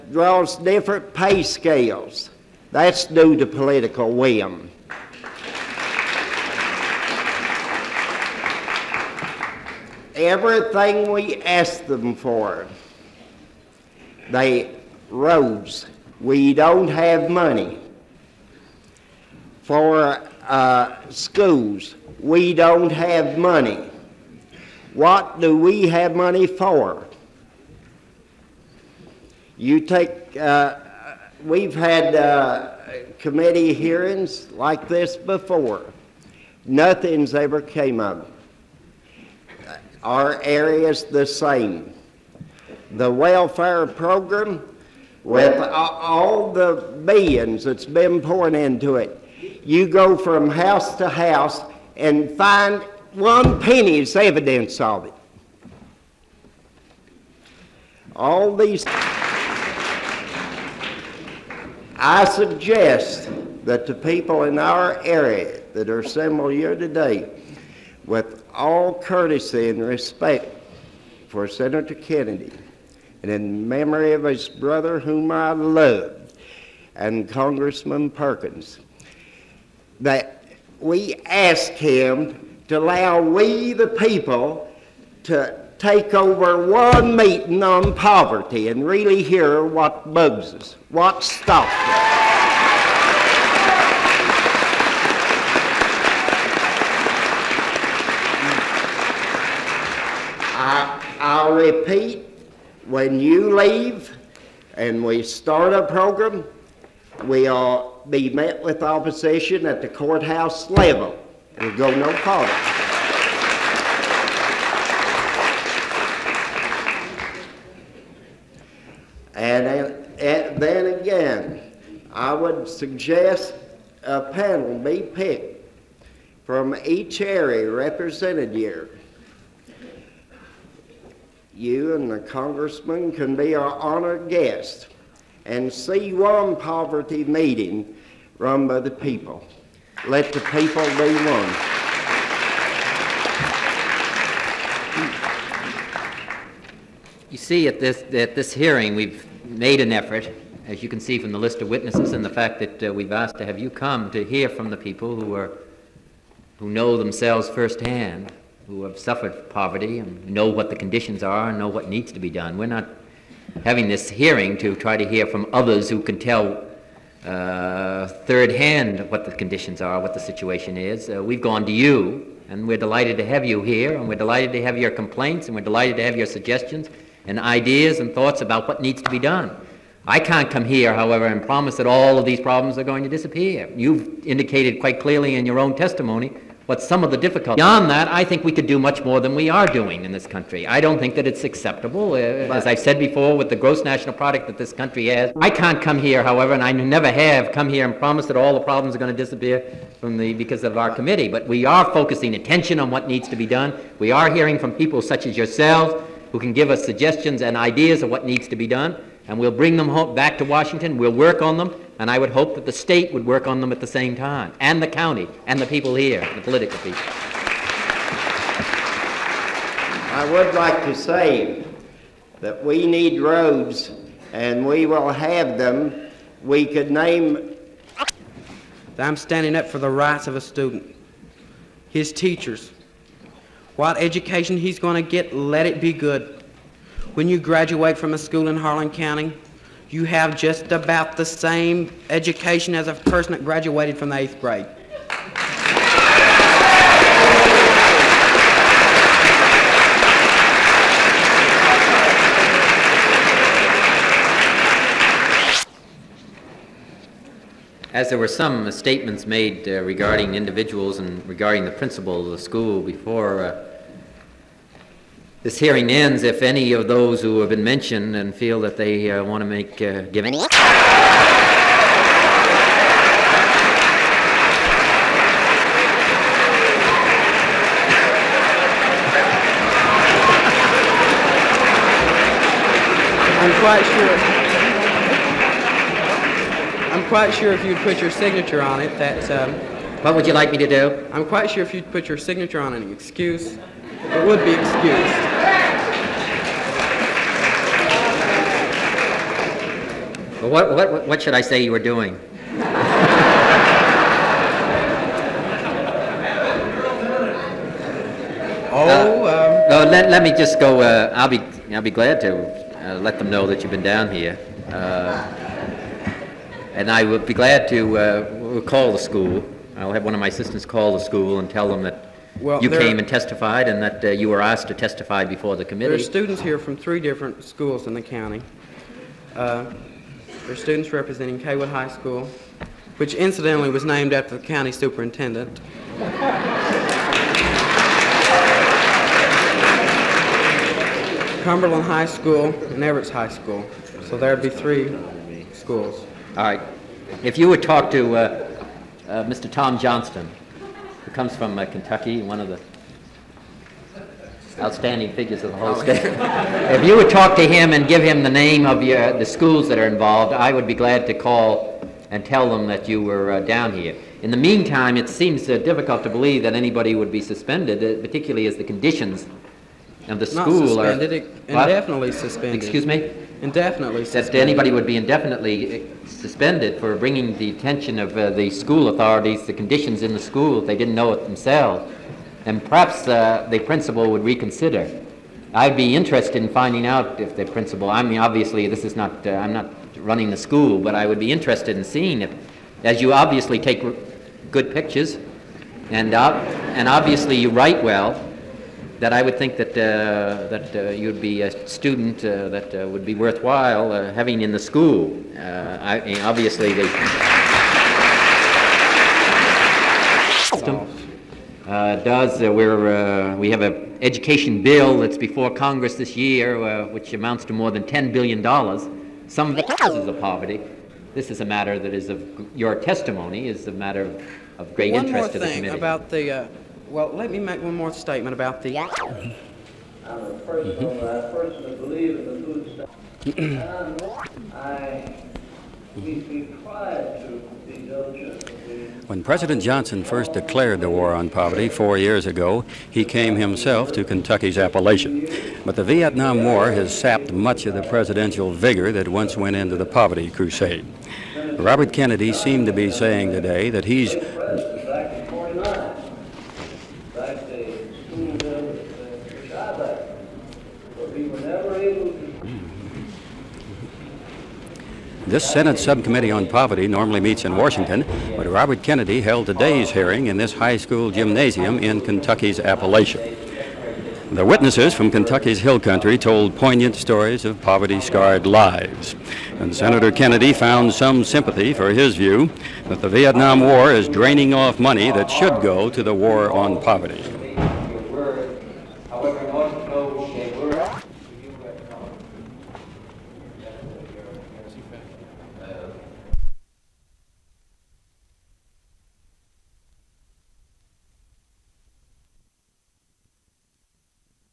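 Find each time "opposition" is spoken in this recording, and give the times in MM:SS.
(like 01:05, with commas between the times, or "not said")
01:48.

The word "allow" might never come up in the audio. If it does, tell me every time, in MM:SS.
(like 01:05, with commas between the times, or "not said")
01:22.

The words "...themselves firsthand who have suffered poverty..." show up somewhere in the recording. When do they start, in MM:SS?
02:36.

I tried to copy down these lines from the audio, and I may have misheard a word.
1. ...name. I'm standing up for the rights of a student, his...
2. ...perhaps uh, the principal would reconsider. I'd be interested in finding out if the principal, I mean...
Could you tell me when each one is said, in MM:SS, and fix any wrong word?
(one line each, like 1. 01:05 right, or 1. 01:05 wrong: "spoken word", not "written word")
1. 03:46 right
2. 06:22 right.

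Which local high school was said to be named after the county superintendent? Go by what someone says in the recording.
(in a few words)
Cawood High School.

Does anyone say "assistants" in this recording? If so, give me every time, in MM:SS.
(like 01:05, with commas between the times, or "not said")
05:20.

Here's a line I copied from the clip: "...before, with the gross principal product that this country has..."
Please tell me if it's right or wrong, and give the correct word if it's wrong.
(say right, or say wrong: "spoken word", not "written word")
wrong: "national", not "principal".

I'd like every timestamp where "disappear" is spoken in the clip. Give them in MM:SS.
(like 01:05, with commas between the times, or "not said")
03:03, 03:19.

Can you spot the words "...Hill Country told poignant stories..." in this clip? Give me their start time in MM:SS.
07:55.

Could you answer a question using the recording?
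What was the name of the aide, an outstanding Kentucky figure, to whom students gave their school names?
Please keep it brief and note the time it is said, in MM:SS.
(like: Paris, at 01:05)
Tom Johnston, at 05:49.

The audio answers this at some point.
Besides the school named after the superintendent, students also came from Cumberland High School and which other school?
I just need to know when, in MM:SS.
05:42.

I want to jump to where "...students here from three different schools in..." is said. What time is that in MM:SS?
05:26.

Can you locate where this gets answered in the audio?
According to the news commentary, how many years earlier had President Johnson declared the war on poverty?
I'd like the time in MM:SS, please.
07:21.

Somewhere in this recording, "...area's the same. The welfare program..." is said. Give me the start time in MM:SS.
00:40.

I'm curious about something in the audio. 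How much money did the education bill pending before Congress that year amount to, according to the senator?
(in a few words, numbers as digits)
more than $10 billion.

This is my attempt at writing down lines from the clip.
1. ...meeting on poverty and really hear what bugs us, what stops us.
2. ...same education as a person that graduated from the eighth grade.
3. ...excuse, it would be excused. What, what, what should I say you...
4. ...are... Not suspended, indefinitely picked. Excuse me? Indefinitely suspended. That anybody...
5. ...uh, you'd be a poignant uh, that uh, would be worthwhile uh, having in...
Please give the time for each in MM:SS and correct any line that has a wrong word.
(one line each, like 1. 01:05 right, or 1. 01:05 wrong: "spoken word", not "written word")
1. 01:27 right
2. 04:01 right
3. 04:52 right
4. 06:10 wrong: "suspended", not "picked"
5. 06:40 wrong: "student", not "poignant".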